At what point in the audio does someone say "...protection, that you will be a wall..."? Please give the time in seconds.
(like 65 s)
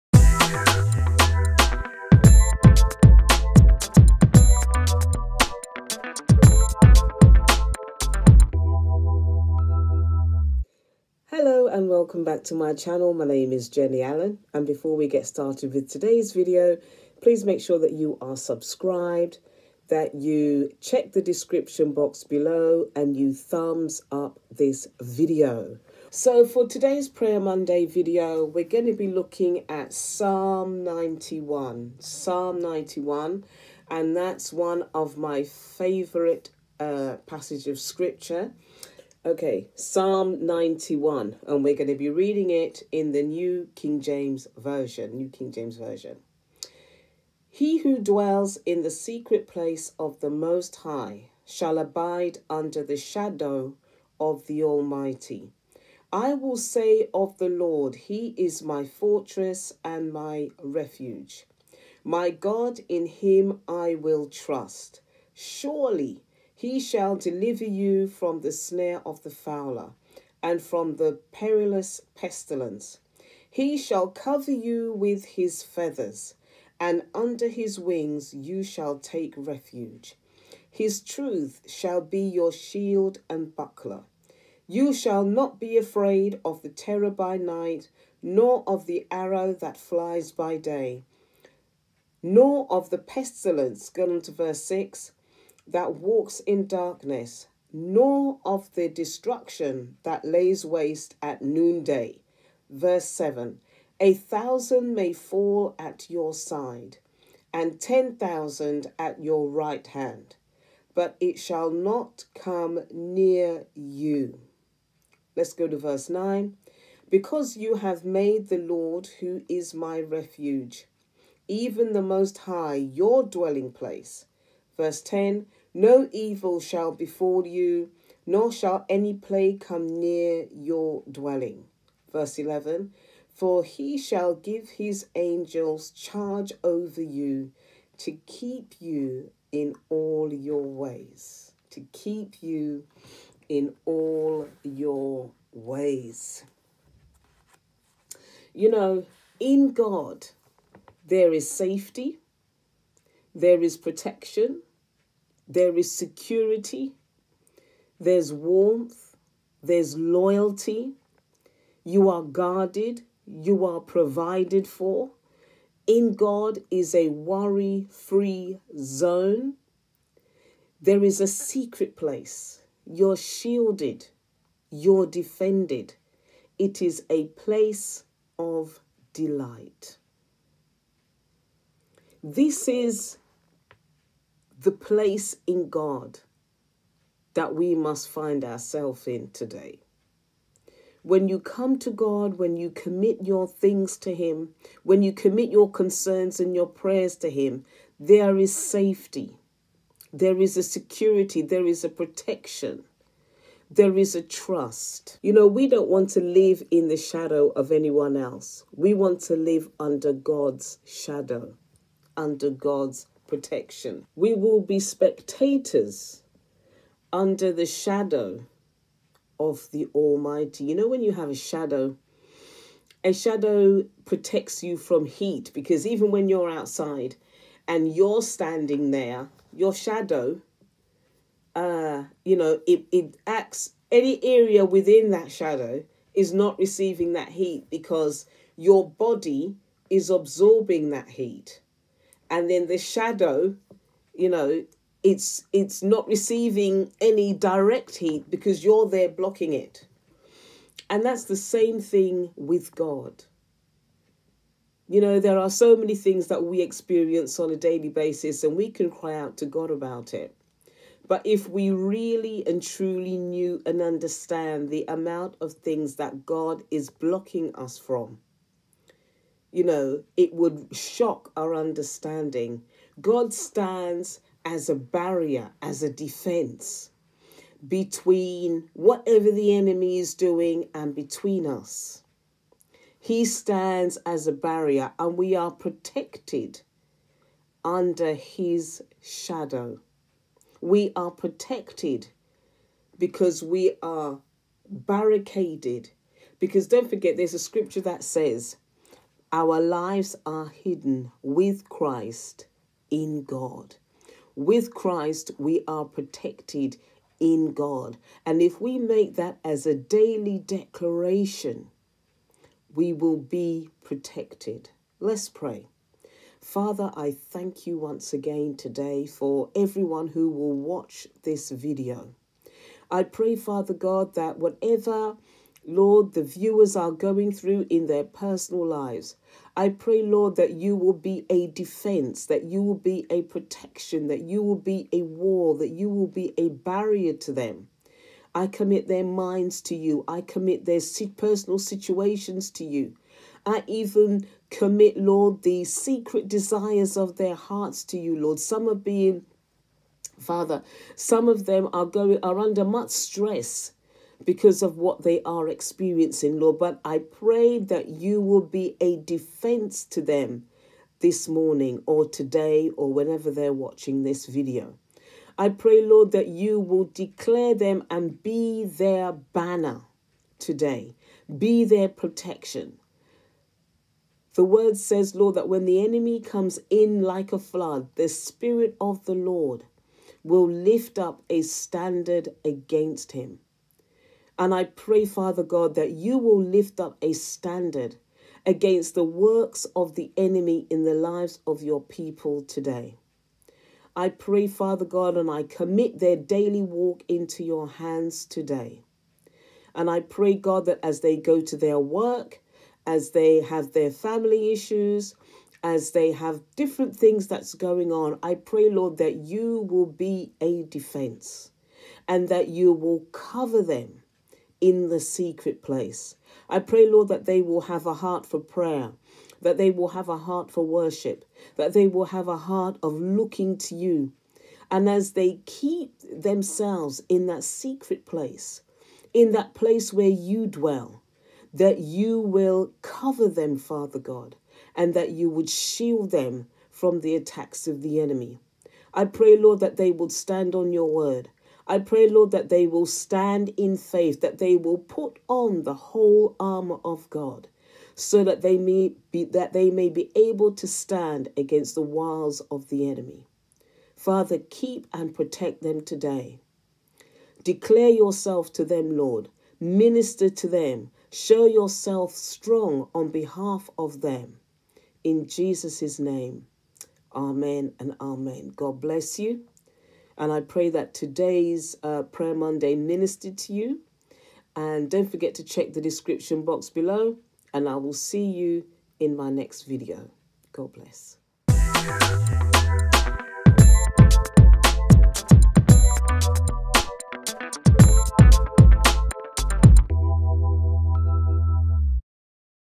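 333 s.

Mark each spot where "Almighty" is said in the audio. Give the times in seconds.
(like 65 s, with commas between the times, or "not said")
54 s, 219 s.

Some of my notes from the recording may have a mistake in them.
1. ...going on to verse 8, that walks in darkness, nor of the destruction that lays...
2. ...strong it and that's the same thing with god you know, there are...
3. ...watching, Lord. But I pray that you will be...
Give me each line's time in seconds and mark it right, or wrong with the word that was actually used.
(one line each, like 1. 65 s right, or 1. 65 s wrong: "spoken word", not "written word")
1. 93 s wrong: "6", not "8"
2. 249 s wrong: "blocking", not "strong"
3. 355 s wrong: "experiencing", not "watching".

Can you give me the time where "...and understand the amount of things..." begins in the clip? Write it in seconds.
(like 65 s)
263 s.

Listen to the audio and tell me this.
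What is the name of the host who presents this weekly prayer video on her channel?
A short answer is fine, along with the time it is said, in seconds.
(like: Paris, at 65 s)
Jenny Allen, at 13 s.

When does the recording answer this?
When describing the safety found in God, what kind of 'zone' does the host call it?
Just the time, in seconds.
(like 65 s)
167 s.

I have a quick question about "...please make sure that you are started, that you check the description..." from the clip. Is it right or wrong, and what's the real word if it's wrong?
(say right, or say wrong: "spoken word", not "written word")
wrong: "subscribed", not "started".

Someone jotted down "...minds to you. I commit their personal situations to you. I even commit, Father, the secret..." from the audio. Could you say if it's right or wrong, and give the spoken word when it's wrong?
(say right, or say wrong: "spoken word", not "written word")
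wrong: "Lord", not "Father".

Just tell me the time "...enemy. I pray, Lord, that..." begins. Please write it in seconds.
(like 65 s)
437 s.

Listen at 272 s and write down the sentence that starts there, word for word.
God stands as a barrier, as a defense between whatever the enemy is doing and between us.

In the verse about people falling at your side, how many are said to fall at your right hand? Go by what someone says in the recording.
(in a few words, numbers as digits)
10,000.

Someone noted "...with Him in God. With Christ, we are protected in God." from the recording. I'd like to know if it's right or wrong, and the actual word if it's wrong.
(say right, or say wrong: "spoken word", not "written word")
wrong: "Christ", not "Him".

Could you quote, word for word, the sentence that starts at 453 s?
Father, keep and protect them today.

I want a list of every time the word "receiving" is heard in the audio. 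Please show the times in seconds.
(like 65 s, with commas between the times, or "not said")
236 s, 246 s.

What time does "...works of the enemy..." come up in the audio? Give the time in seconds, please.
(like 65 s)
389 s.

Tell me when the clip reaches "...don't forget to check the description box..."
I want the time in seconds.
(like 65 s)
474 s.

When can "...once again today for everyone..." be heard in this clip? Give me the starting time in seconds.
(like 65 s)
317 s.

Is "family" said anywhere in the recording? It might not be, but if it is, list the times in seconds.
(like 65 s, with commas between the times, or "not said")
403 s.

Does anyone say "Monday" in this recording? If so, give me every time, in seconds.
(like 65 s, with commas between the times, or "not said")
27 s, 472 s.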